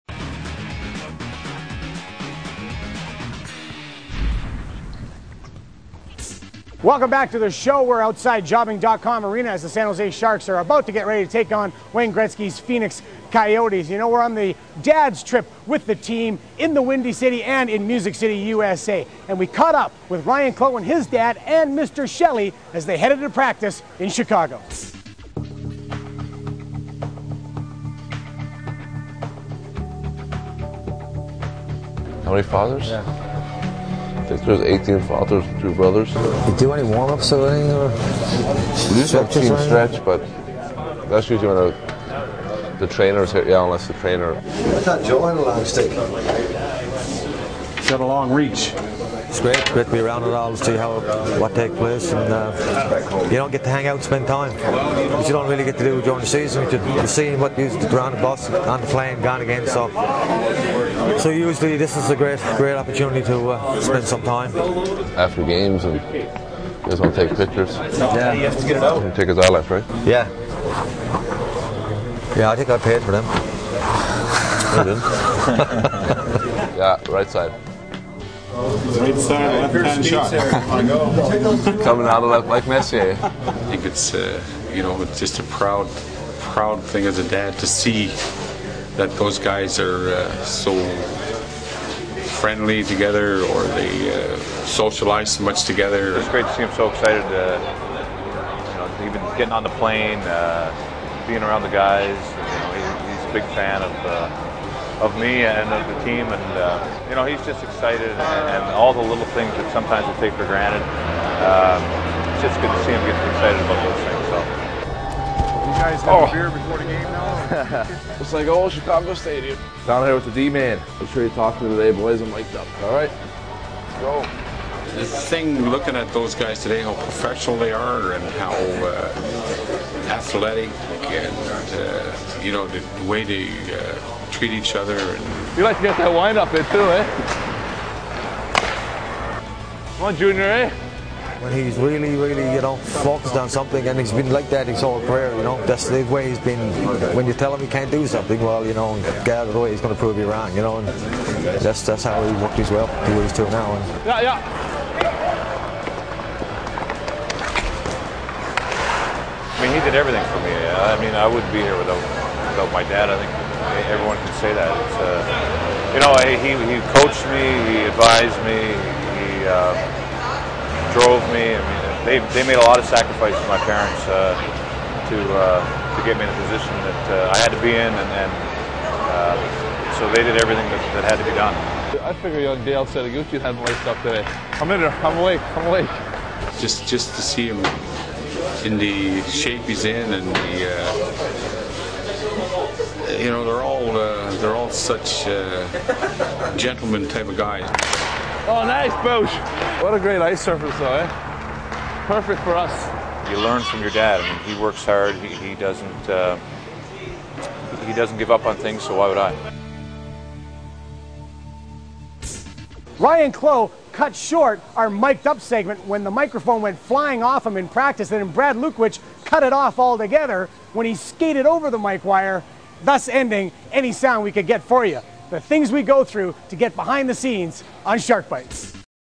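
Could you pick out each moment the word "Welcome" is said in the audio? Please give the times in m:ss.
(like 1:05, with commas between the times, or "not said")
0:06.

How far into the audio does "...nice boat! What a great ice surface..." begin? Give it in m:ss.
3:18.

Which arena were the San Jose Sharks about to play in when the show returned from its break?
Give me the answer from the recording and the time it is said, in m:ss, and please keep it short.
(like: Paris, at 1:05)
Jobing.com Arena, at 0:08.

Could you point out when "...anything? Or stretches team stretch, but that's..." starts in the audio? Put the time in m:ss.
0:37.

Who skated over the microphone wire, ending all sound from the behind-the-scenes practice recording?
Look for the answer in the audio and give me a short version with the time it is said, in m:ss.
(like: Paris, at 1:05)
Brad Lukowich, at 3:38.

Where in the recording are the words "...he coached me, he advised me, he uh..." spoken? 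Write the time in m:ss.
2:46.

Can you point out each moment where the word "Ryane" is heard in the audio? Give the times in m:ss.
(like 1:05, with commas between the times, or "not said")
0:20, 3:32.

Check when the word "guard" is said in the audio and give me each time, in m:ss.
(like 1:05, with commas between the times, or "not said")
not said.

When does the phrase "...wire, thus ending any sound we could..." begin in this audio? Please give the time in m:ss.
3:42.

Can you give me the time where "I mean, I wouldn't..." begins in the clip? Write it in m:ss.
2:40.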